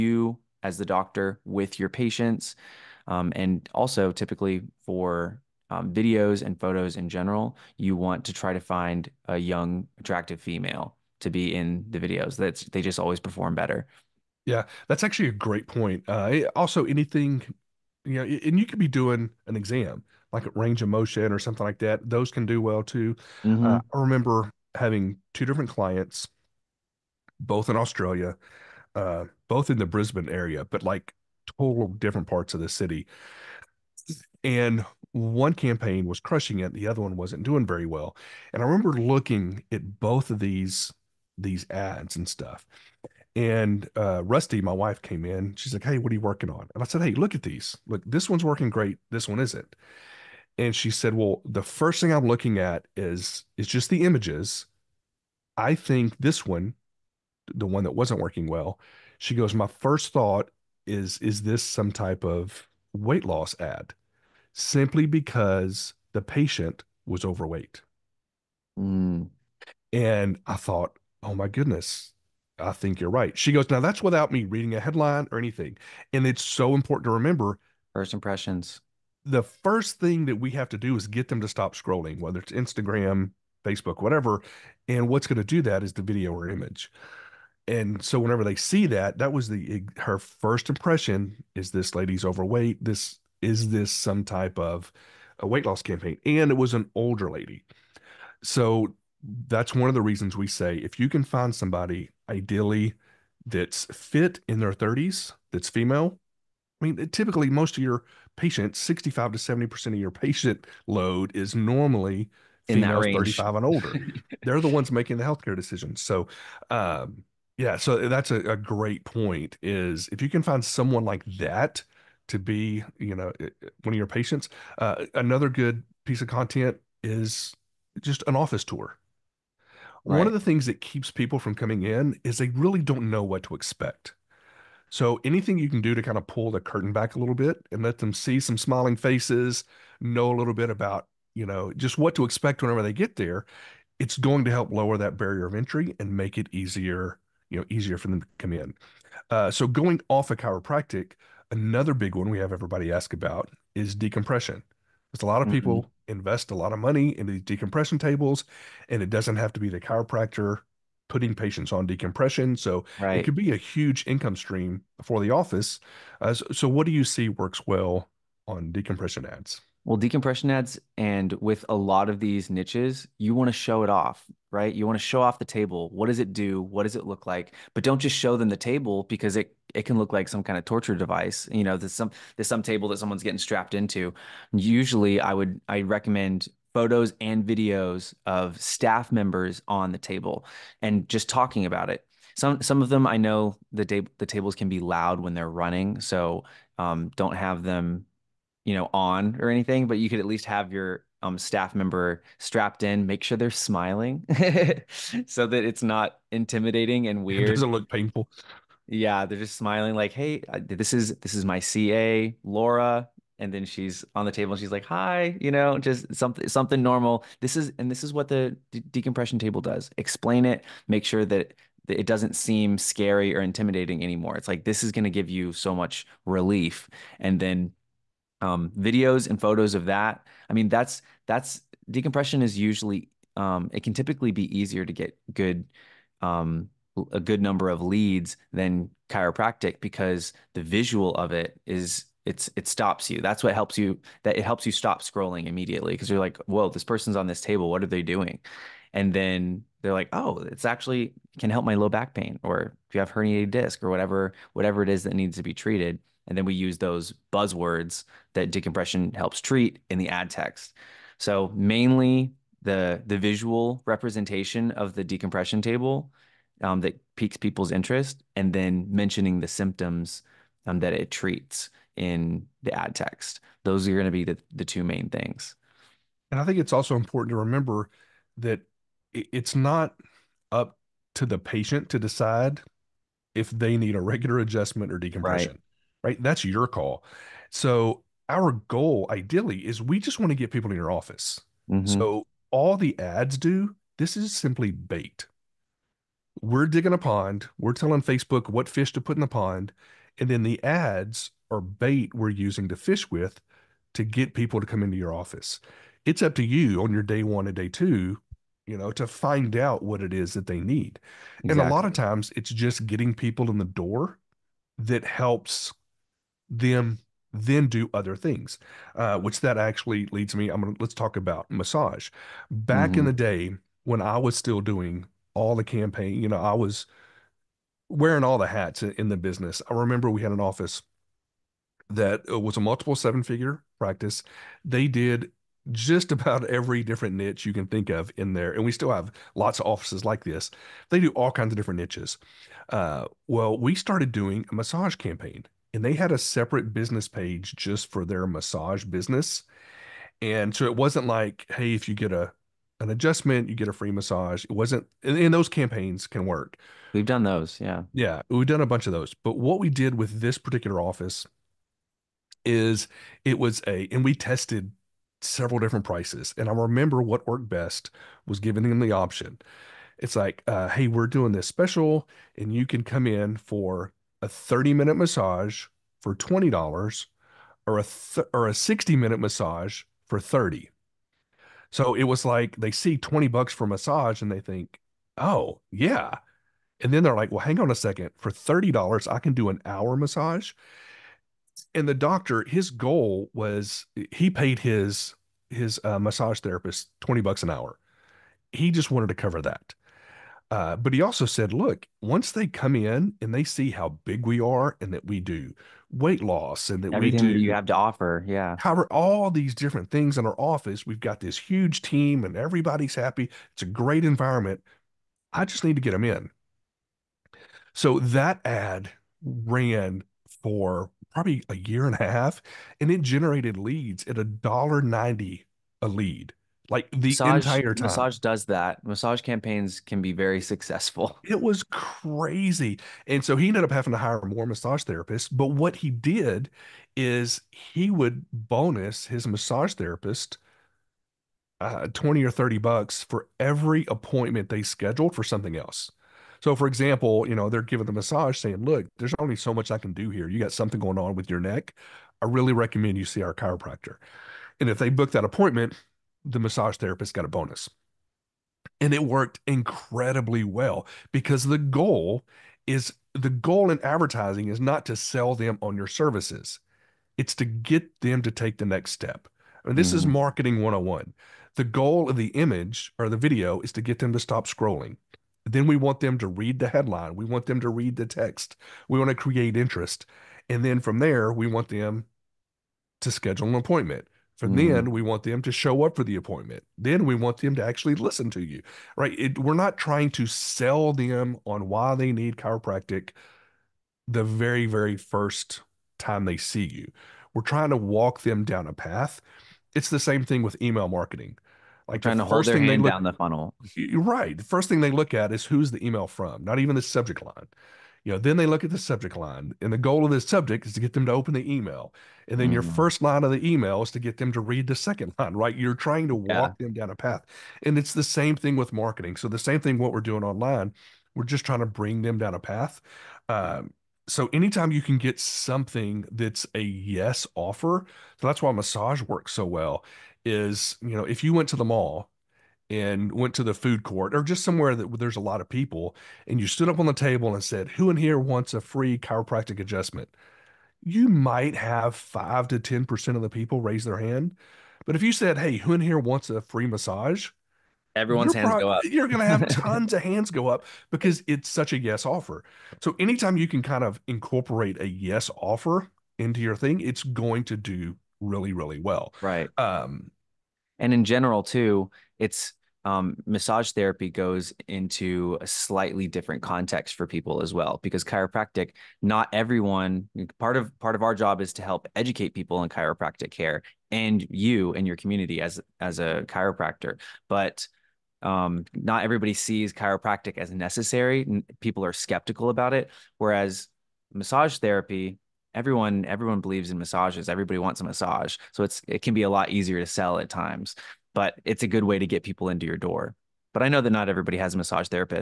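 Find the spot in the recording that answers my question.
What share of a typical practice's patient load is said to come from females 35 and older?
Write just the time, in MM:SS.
01:48.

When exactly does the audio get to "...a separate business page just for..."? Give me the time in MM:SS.
05:46.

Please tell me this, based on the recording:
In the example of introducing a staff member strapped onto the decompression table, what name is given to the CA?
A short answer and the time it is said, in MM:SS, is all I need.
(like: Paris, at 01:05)
Laura, at 03:32.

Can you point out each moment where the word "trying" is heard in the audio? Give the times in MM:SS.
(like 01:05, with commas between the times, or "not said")
08:09, 08:17, 08:22, 08:35, 08:41.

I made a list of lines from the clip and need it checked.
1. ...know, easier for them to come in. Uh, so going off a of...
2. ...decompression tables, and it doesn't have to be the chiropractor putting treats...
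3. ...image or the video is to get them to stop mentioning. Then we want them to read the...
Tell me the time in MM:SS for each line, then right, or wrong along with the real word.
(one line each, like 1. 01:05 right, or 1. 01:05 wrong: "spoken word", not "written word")
1. 02:27 right
2. 02:37 wrong: "patients", not "treats"
3. 07:52 wrong: "scrolling", not "mentioning".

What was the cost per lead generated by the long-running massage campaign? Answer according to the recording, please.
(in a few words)
$1.90.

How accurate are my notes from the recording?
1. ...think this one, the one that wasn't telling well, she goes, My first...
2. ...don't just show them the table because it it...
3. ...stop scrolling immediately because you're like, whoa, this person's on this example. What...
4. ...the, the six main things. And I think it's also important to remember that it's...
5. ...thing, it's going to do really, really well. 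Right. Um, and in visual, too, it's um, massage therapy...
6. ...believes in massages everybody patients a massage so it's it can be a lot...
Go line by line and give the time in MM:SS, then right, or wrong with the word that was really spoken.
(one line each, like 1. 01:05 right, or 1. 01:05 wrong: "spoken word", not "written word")
1. 00:55 wrong: "working", not "telling"
2. 02:57 right
3. 04:04 wrong: "table", not "example"
4. 04:34 wrong: "two", not "six"
5. 09:16 wrong: "general", not "visual"
6. 09:46 wrong: "wants", not "patients".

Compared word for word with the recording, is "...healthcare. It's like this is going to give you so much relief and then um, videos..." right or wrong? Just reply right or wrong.
wrong.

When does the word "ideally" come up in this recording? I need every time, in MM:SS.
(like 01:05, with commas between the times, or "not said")
01:42, 04:49.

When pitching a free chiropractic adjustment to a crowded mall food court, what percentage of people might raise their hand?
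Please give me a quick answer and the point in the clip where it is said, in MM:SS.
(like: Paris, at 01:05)
5 to 10%, at 09:01.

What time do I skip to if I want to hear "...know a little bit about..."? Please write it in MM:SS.
02:19.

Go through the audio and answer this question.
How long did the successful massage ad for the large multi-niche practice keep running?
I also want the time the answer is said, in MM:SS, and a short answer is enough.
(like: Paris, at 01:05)
a year and a half, at 07:01.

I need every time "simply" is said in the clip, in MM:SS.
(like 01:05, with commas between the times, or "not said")
01:04, 04:54.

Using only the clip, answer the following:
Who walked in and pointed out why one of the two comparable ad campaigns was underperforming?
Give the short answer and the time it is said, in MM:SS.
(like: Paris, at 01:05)
Rusty, at 00:44.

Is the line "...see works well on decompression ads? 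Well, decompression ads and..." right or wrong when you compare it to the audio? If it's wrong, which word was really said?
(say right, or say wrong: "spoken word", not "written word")
right.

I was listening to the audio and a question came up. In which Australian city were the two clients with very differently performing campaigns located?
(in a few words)
Brisbane.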